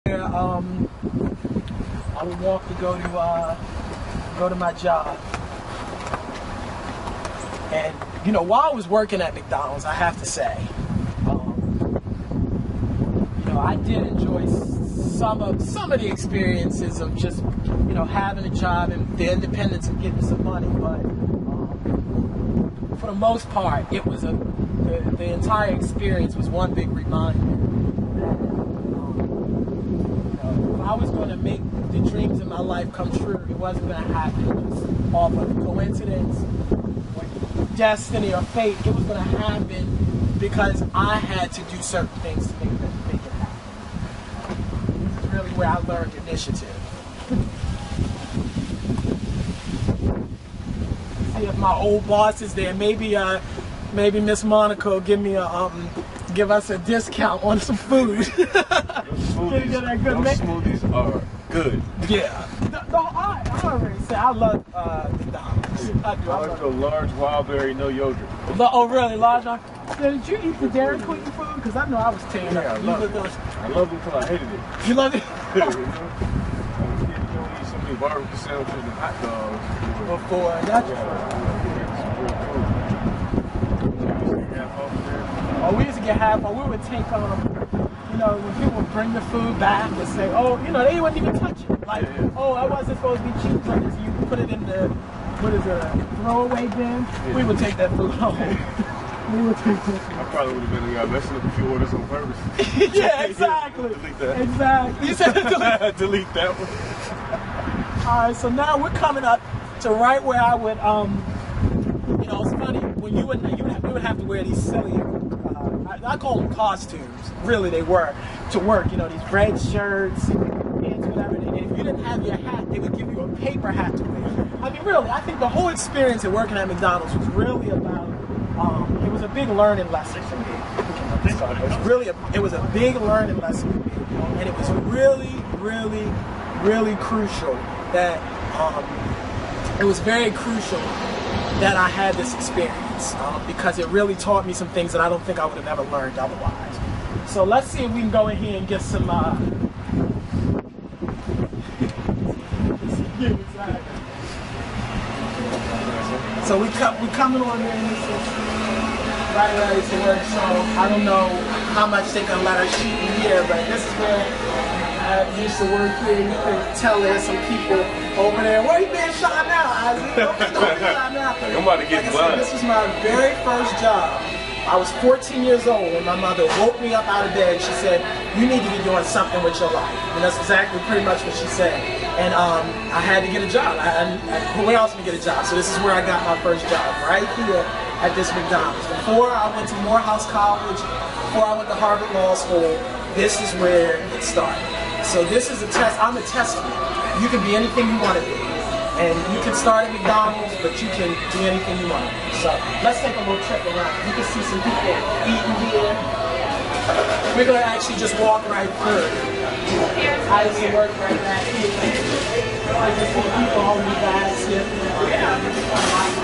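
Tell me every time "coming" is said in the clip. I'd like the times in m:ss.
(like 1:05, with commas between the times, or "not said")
1:48, 2:37.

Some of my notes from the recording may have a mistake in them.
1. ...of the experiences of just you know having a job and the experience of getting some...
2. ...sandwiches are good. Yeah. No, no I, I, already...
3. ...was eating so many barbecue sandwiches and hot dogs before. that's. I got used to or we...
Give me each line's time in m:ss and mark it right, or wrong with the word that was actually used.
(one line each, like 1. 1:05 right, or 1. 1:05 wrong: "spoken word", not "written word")
1. 0:15 wrong: "independence", not "experience"
2. 1:00 wrong: "smoothies", not "sandwiches"
3. 1:16 right.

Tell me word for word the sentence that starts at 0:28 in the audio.
That, um, I was going to make the dreams in my life come true.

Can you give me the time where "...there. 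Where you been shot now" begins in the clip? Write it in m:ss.
2:48.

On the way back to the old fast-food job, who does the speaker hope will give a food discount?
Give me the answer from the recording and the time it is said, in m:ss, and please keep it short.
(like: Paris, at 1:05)
Miss Monica, at 0:54.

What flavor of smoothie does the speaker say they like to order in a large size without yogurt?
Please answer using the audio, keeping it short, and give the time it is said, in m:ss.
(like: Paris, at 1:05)
Wild berry, at 1:07.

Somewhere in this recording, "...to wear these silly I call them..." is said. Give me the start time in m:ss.
1:54.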